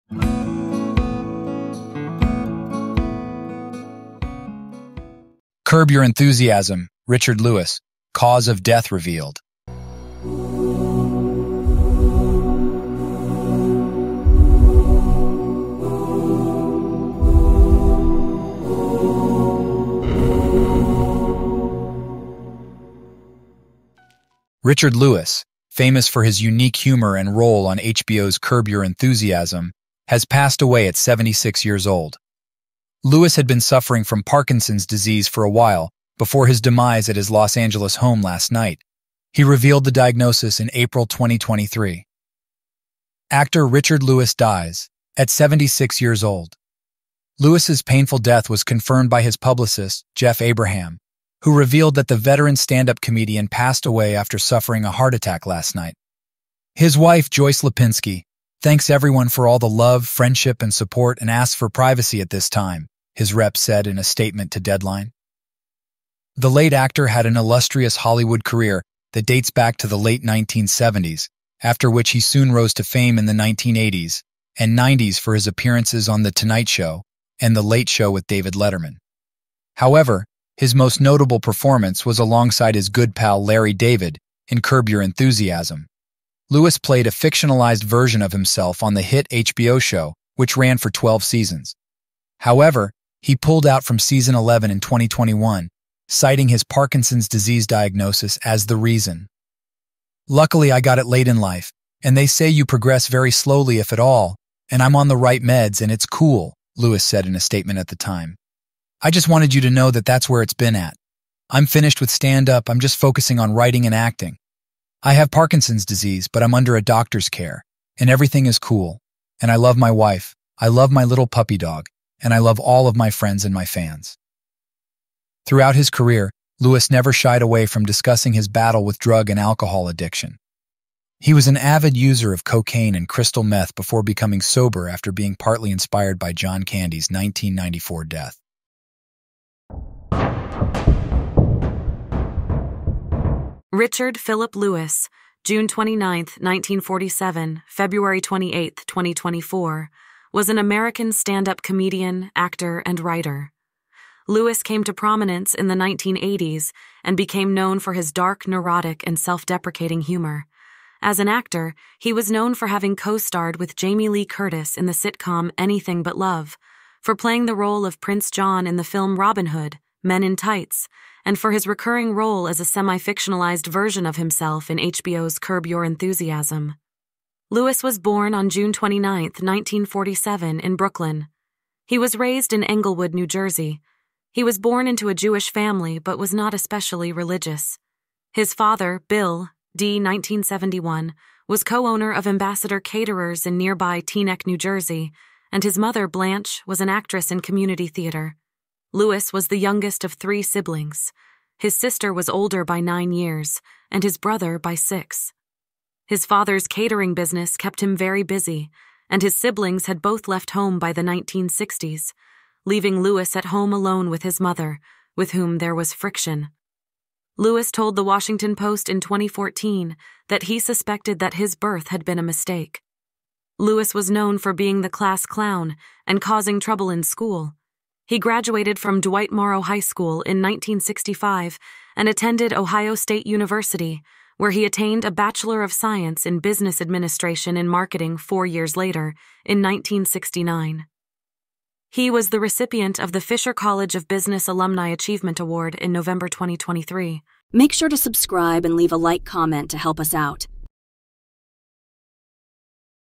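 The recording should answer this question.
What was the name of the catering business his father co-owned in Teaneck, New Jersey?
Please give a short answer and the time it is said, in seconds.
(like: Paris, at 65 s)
Ambassador Caterers, at 192 s.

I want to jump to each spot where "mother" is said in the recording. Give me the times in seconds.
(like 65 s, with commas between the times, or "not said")
195 s, 214 s.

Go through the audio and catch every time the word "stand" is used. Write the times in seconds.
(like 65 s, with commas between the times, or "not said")
52 s, 112 s, 151 s.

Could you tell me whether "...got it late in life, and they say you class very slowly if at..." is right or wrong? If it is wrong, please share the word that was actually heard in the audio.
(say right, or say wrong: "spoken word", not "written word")
wrong: "progress", not "class".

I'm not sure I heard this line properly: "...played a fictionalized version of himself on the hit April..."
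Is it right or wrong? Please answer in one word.
wrong.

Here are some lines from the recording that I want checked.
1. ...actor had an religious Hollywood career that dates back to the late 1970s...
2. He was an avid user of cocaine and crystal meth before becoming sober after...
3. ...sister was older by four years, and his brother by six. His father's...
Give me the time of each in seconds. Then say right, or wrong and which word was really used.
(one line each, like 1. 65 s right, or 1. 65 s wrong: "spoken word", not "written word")
1. 66 s wrong: "illustrious", not "religious"
2. 131 s right
3. 201 s wrong: "nine", not "four".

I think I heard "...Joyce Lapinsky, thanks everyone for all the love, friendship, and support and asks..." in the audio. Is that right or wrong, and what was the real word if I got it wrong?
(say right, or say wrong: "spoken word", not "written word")
right.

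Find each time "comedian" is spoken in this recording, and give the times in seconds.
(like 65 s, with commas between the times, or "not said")
53 s, 151 s.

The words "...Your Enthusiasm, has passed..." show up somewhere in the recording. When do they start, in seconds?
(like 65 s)
28 s.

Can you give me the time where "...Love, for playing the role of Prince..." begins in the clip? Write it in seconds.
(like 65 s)
166 s.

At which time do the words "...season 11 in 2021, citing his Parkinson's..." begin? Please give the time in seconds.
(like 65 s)
93 s.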